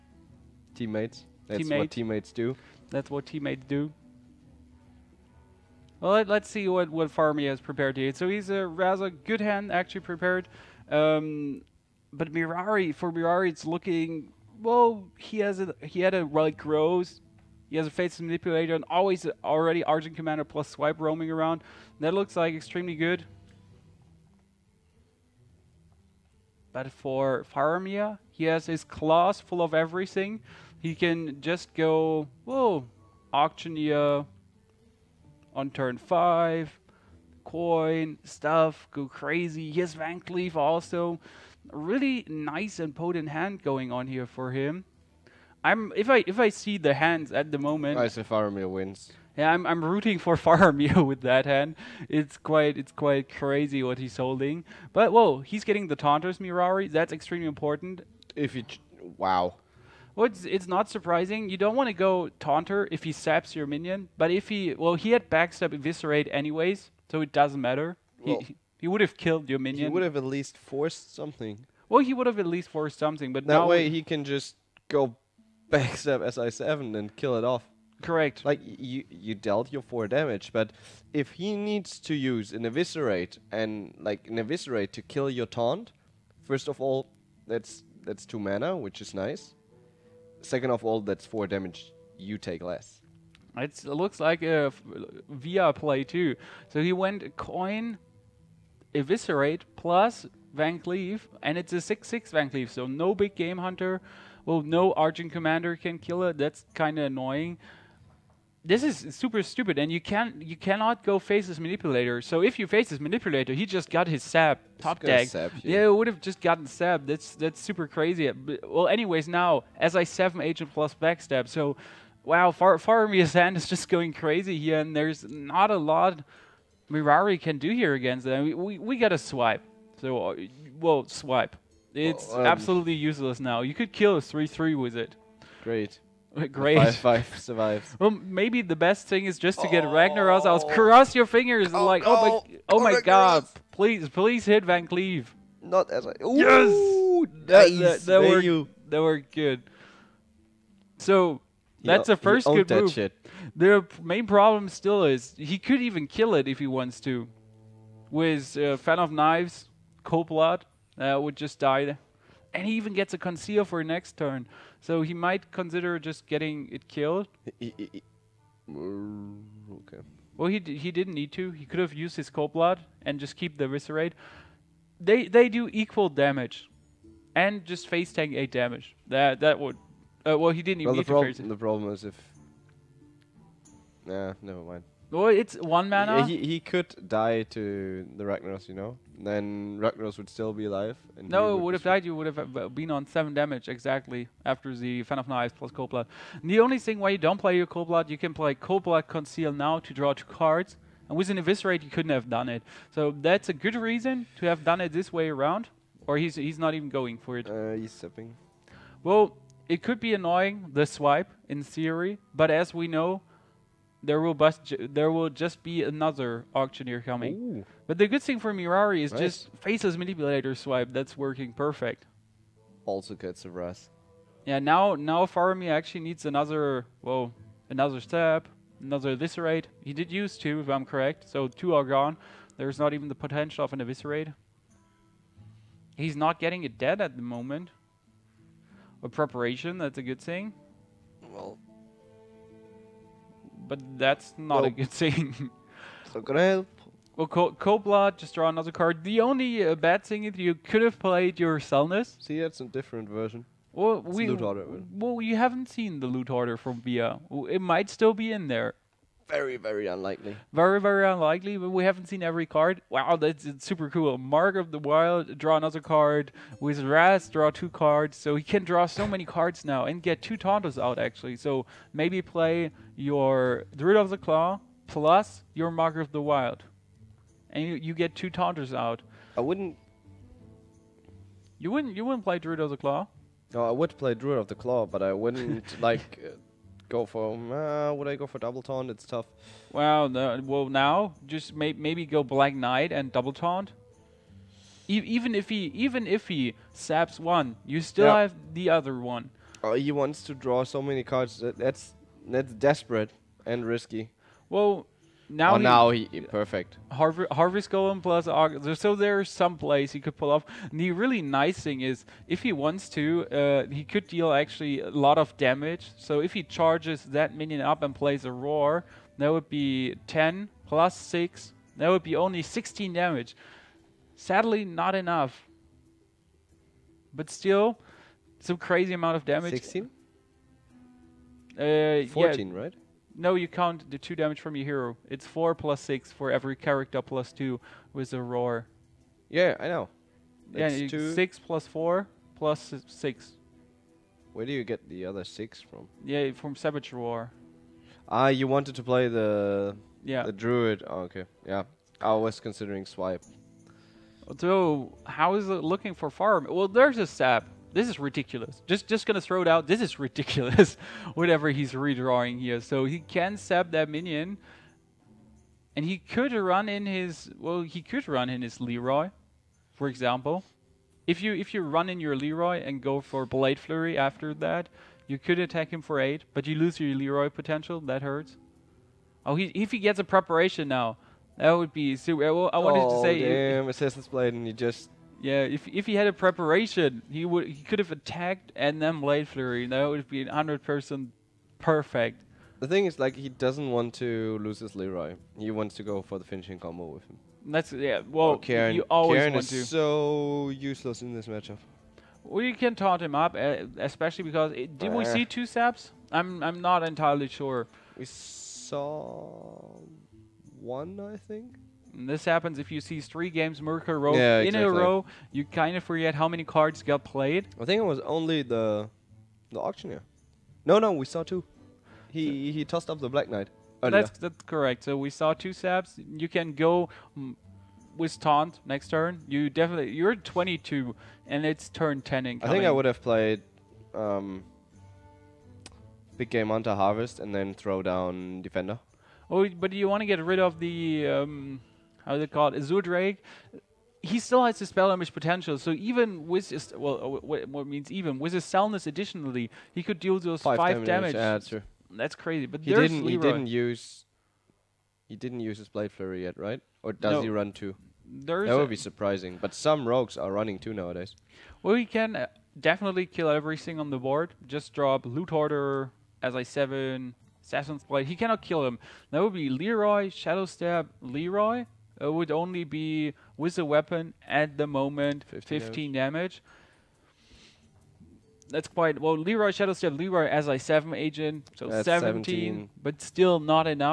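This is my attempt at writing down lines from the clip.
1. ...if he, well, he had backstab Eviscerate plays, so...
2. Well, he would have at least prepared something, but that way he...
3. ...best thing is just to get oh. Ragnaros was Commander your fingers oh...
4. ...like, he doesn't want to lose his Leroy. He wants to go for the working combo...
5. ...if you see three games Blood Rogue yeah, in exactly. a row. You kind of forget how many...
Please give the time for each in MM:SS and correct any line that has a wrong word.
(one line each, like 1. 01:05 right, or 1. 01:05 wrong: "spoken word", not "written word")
1. 01:04 wrong: "anyways", not "plays"
2. 01:11 wrong: "forced", not "prepared"
3. 02:18 wrong: "Cross", not "Commander"
4. 06:32 wrong: "finishing", not "working"
5. 06:52 wrong: "Miracle", not "Blood".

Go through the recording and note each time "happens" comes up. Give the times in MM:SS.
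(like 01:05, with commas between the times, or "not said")
06:52.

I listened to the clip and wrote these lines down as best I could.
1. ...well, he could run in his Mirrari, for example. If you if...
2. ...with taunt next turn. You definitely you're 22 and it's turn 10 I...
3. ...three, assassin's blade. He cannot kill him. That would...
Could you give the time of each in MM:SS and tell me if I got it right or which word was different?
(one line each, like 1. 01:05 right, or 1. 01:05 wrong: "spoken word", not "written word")
1. 06:07 wrong: "Leroy", not "Mirrari"
2. 07:07 right
3. 07:46 wrong: "seven", not "three".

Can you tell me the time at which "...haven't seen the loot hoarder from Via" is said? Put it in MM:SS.
04:15.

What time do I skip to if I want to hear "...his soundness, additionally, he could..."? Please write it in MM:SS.
07:28.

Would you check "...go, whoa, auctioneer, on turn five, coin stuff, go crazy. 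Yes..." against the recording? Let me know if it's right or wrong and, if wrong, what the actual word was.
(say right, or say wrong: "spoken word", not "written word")
right.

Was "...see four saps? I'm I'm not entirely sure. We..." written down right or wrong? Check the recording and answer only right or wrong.
wrong.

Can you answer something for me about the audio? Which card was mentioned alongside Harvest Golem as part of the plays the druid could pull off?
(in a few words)
Argus.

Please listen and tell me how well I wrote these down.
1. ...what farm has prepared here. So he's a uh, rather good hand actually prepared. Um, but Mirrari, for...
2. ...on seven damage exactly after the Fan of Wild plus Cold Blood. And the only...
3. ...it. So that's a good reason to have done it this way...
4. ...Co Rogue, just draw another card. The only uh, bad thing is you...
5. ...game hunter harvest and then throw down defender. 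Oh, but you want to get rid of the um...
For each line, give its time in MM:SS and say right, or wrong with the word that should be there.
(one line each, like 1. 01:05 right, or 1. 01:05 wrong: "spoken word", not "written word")
1. 00:06 right
2. 03:12 wrong: "Knives", not "Wild"
3. 03:22 right
4. 04:07 wrong: "Cobla", not "Rogue"
5. 07:16 right.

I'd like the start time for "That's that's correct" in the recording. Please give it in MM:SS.
07:04.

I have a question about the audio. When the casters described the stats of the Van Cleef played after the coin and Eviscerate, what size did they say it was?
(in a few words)
6/6.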